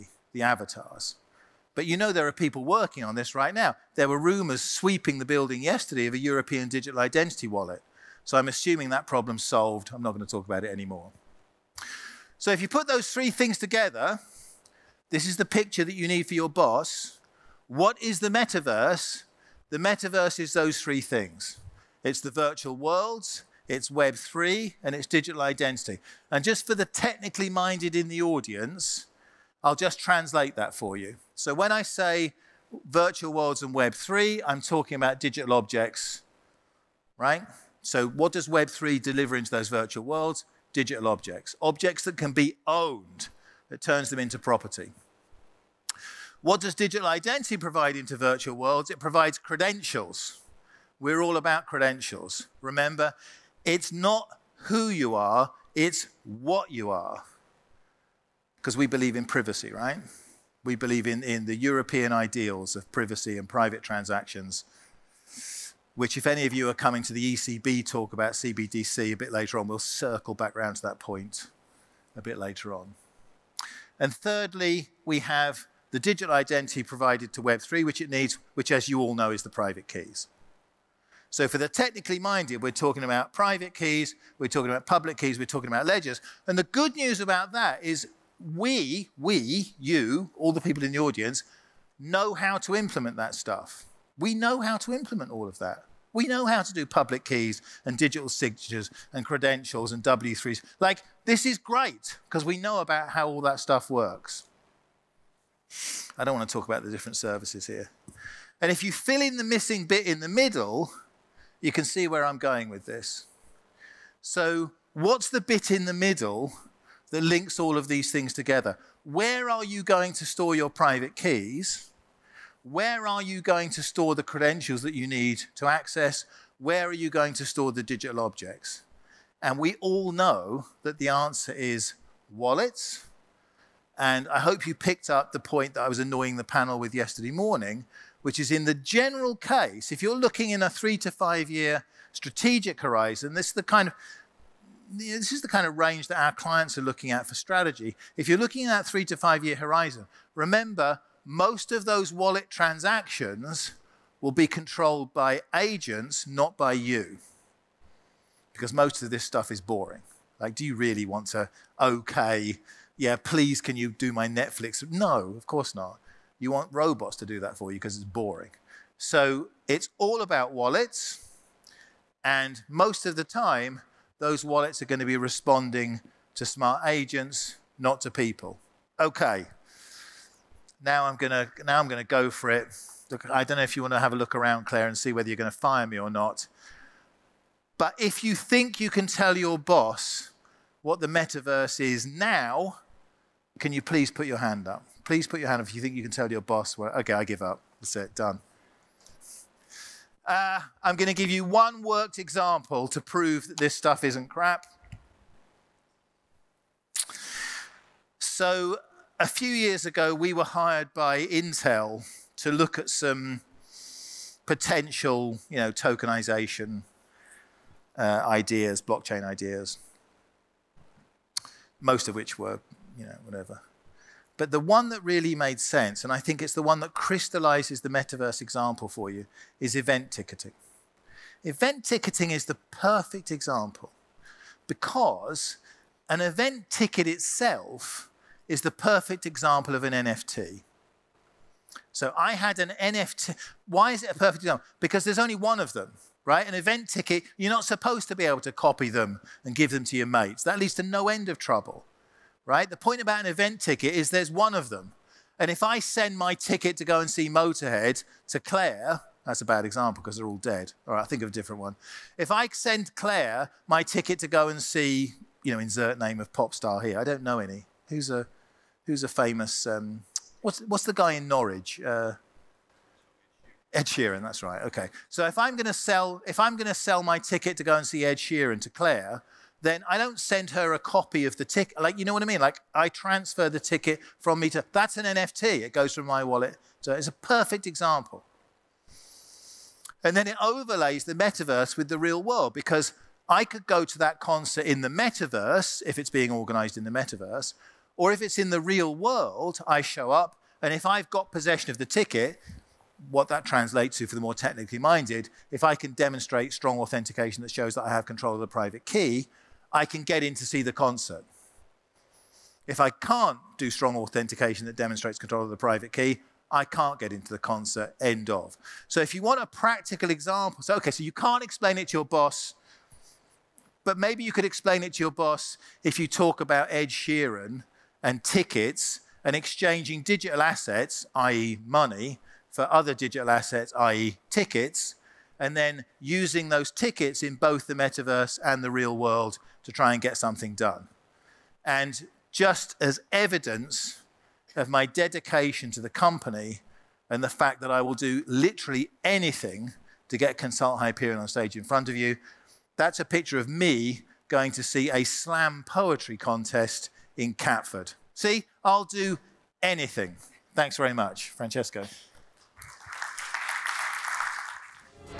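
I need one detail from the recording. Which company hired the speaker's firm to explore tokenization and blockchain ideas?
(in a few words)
Intel.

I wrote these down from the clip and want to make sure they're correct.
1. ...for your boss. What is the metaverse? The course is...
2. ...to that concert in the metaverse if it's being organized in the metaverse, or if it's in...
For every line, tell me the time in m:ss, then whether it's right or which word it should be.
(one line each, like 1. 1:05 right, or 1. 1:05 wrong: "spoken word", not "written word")
1. 0:16 wrong: "metaverse", not "course"
2. 4:53 right.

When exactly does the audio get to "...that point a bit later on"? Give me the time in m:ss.
1:10.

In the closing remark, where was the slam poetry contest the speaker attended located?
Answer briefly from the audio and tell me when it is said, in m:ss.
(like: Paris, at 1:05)
Catford, at 5:57.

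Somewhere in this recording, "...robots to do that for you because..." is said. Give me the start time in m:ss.
2:46.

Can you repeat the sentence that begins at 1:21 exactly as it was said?
So for the technically minded, we're talking about private keys, we're talking about public keys, we're talking about ledgers.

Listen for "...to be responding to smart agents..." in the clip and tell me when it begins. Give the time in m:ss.
2:54.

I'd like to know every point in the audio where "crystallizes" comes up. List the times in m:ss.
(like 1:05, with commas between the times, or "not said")
3:46.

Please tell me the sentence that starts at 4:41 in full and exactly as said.
Like, you know what I mean?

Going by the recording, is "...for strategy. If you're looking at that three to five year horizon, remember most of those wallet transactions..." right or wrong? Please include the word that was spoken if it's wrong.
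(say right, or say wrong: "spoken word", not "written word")
right.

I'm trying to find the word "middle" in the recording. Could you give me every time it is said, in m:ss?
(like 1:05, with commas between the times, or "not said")
1:50, 1:55.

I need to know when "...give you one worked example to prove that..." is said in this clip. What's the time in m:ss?
3:21.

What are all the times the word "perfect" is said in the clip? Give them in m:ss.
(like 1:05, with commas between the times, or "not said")
3:52, 3:58, 4:04, 4:47.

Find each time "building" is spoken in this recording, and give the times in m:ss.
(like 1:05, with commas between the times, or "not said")
0:05.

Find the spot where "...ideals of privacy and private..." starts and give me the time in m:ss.
1:02.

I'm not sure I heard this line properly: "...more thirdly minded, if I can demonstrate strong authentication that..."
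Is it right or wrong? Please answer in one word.
wrong.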